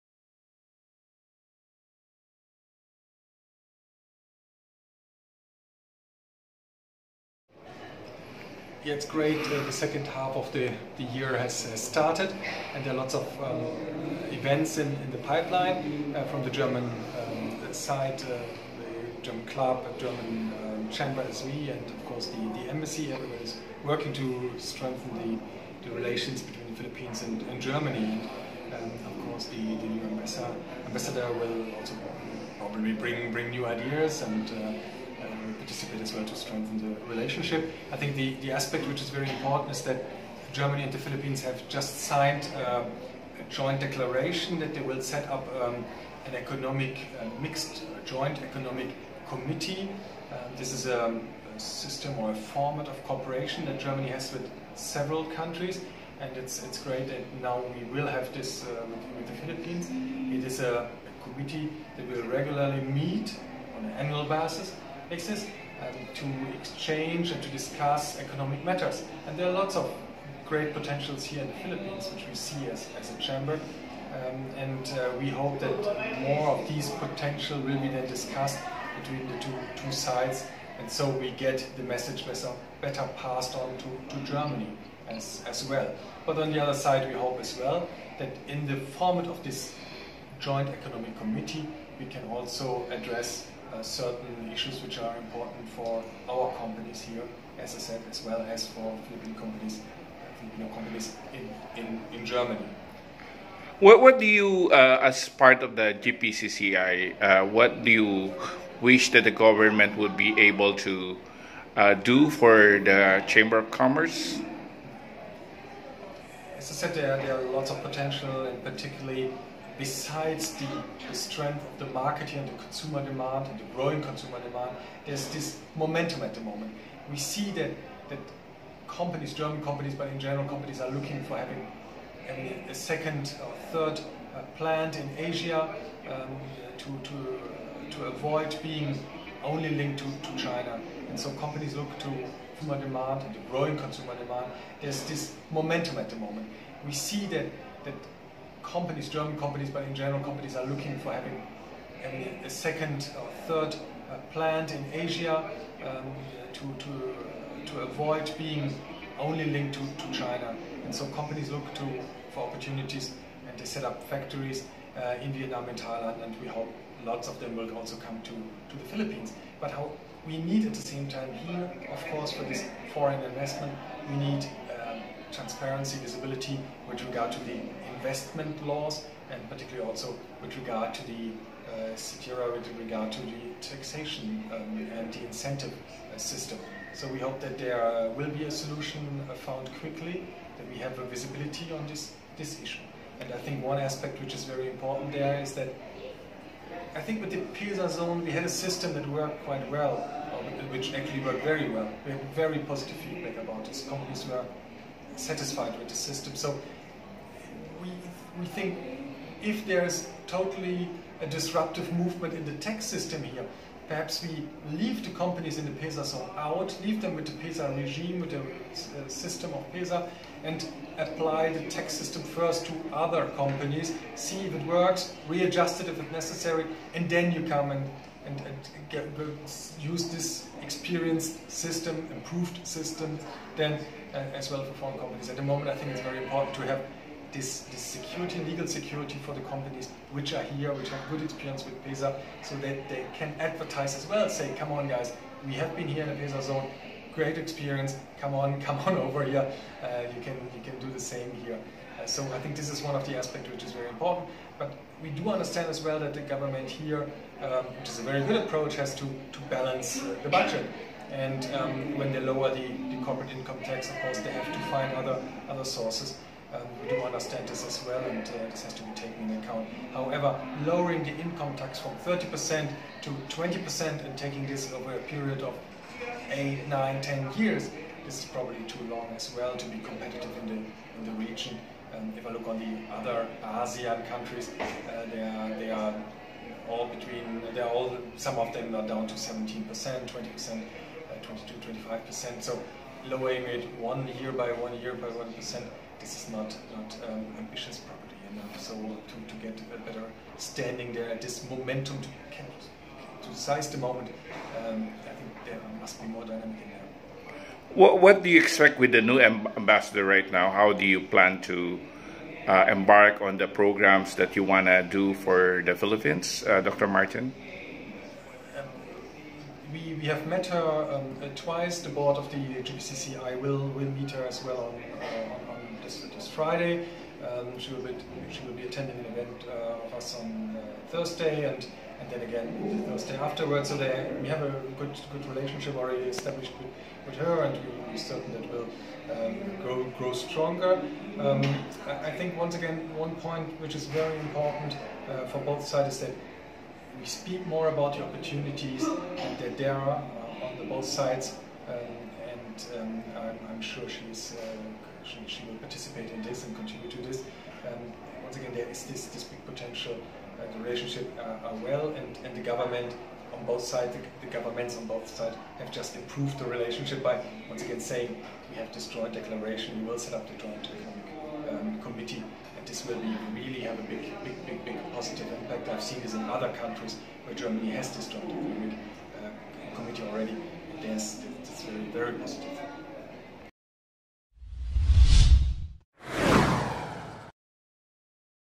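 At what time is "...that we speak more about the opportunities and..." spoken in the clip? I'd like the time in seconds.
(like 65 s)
346 s.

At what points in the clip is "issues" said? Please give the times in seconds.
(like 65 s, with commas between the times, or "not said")
94 s, 192 s.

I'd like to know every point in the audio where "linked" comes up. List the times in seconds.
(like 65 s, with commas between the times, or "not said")
139 s, 159 s.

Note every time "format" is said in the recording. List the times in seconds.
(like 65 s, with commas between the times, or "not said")
52 s, 88 s.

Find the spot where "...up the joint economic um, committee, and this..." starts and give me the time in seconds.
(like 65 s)
370 s.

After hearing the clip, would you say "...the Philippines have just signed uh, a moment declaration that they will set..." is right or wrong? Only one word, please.
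wrong.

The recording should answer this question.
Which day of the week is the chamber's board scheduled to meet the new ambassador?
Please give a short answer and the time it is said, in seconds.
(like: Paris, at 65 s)
Friday, at 326 s.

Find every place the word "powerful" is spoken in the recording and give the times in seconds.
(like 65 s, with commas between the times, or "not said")
not said.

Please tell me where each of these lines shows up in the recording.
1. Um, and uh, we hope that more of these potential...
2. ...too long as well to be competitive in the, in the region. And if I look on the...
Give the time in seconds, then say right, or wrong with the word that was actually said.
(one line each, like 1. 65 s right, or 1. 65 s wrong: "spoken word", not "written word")
1. 74 s right
2. 278 s right.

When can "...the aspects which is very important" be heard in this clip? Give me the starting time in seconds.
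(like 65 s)
253 s.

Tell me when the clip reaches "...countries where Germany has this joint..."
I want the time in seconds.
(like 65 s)
376 s.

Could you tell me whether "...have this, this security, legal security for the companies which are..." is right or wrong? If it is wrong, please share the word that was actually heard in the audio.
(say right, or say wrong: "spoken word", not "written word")
right.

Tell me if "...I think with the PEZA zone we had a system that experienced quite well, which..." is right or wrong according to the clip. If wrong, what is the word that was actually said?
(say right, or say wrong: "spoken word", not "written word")
wrong: "worked", not "experienced".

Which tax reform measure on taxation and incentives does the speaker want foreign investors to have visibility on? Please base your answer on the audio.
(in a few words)
CITIRA.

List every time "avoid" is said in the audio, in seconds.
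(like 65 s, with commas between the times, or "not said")
138 s, 157 s.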